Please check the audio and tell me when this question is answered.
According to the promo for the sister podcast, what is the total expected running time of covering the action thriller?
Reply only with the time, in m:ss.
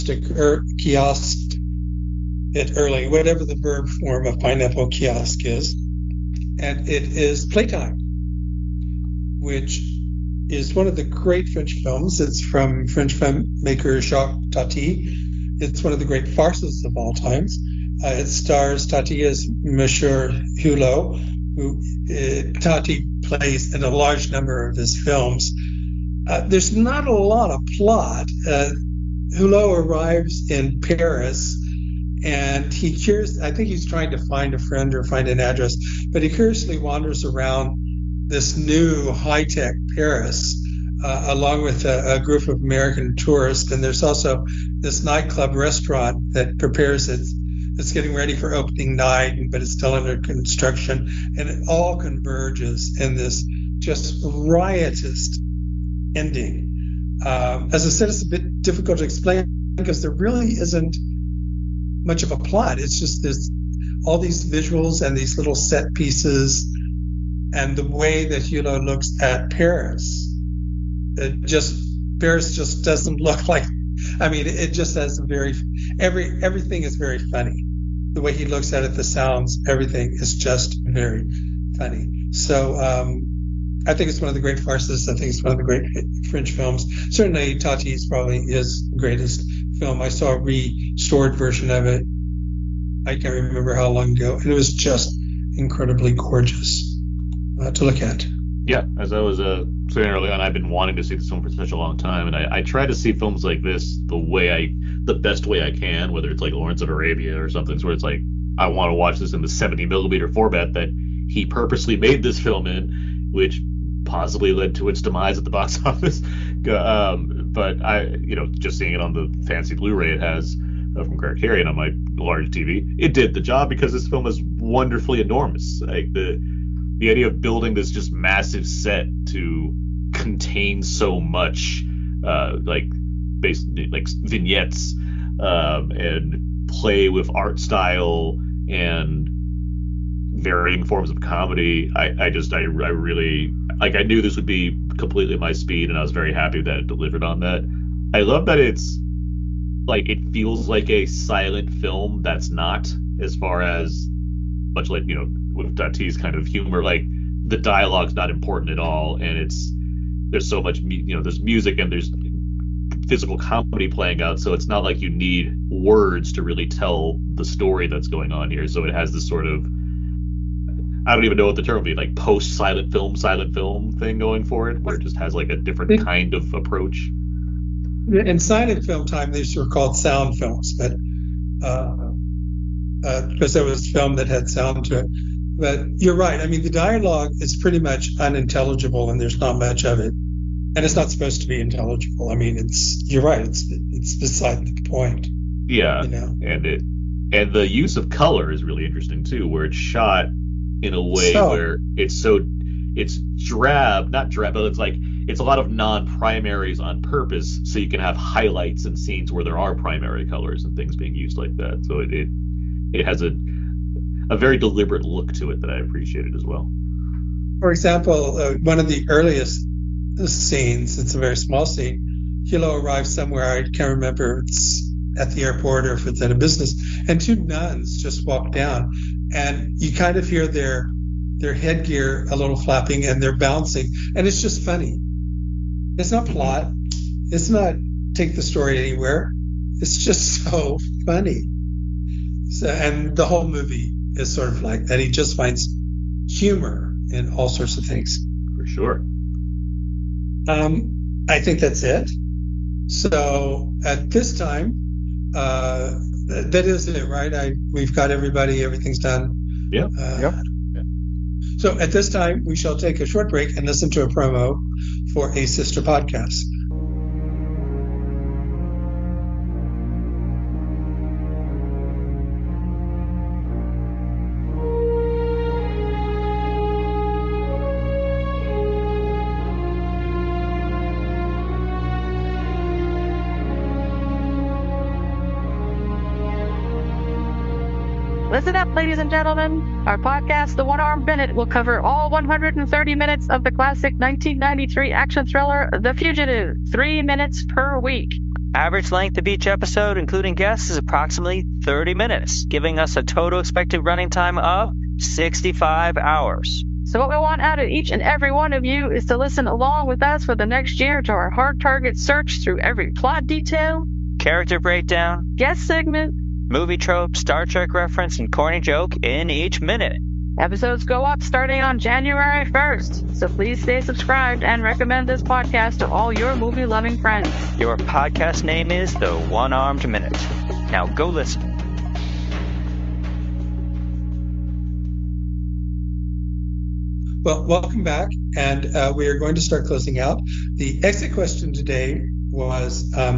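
5:04.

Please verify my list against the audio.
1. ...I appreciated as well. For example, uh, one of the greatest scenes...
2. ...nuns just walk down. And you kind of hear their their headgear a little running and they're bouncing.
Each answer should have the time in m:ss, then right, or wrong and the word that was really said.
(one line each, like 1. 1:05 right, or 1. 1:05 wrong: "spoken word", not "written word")
1. 3:35 wrong: "earliest", not "greatest"
2. 3:47 wrong: "flapping", not "running".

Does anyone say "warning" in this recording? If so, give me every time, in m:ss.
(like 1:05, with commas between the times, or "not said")
not said.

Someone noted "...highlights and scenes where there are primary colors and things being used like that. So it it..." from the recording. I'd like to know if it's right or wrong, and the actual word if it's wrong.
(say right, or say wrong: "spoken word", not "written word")
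right.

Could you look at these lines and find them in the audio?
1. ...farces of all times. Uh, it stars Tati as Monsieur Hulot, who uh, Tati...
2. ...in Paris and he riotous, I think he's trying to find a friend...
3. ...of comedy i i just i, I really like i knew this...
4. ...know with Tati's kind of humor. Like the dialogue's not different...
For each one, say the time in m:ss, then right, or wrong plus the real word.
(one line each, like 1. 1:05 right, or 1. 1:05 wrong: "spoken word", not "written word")
1. 0:16 right
2. 0:30 wrong: "curious", not "riotous"
3. 2:21 right
4. 2:35 wrong: "important", not "different".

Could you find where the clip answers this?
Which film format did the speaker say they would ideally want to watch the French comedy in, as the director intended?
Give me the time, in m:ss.
1:49.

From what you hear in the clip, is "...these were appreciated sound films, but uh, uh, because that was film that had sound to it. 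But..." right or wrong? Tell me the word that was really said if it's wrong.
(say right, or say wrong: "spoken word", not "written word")
wrong: "called", not "appreciated".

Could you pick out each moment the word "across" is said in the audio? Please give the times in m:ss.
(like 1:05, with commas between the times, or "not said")
not said.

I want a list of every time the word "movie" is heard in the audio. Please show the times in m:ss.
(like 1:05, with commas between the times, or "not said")
4:03, 5:16, 5:26.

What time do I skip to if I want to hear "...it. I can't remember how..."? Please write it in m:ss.
1:31.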